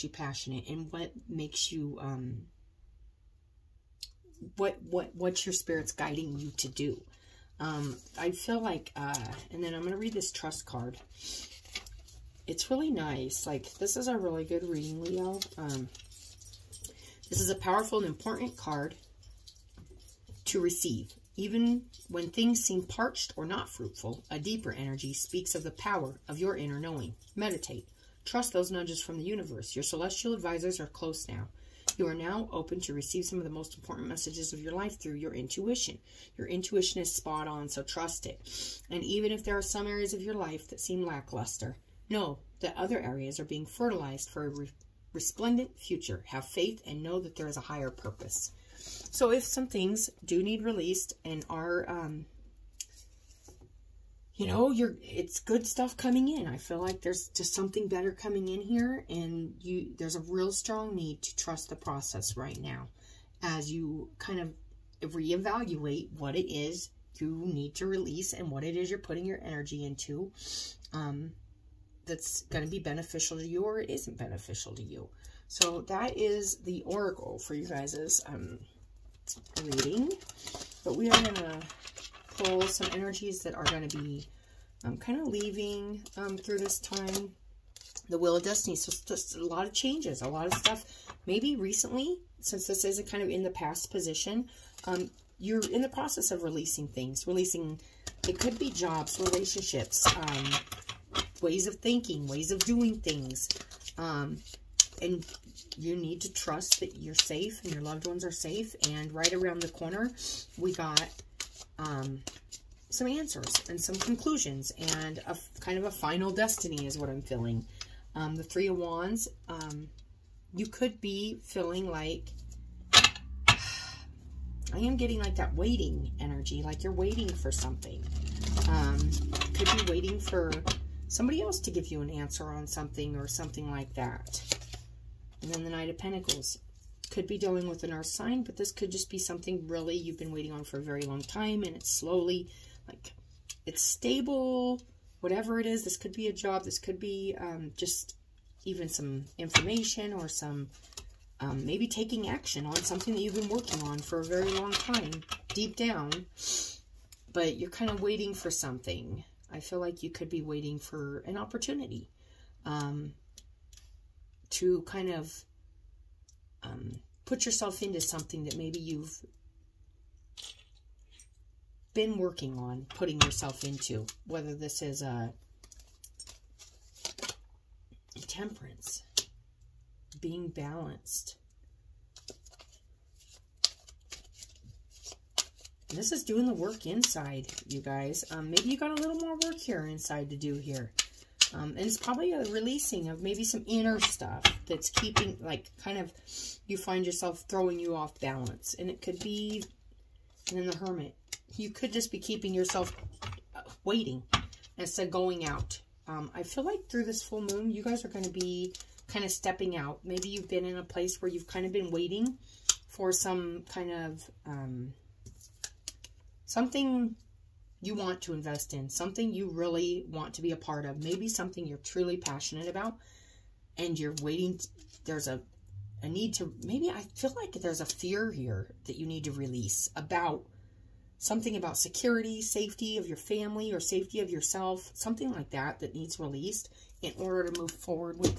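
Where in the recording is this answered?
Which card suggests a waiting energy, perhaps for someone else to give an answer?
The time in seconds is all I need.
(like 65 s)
118 s.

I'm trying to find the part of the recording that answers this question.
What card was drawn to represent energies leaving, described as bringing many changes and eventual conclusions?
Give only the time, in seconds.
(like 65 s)
88 s.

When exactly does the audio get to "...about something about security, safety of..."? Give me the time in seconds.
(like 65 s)
229 s.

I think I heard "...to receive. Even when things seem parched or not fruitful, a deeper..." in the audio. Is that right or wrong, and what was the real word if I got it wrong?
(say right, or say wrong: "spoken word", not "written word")
right.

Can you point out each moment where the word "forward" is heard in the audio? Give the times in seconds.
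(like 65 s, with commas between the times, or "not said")
237 s.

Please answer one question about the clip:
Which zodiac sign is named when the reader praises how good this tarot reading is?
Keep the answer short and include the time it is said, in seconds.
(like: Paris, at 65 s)
Leo, at 15 s.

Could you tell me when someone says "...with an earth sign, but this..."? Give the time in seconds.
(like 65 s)
137 s.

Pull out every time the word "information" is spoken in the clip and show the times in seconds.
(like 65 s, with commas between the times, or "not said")
149 s.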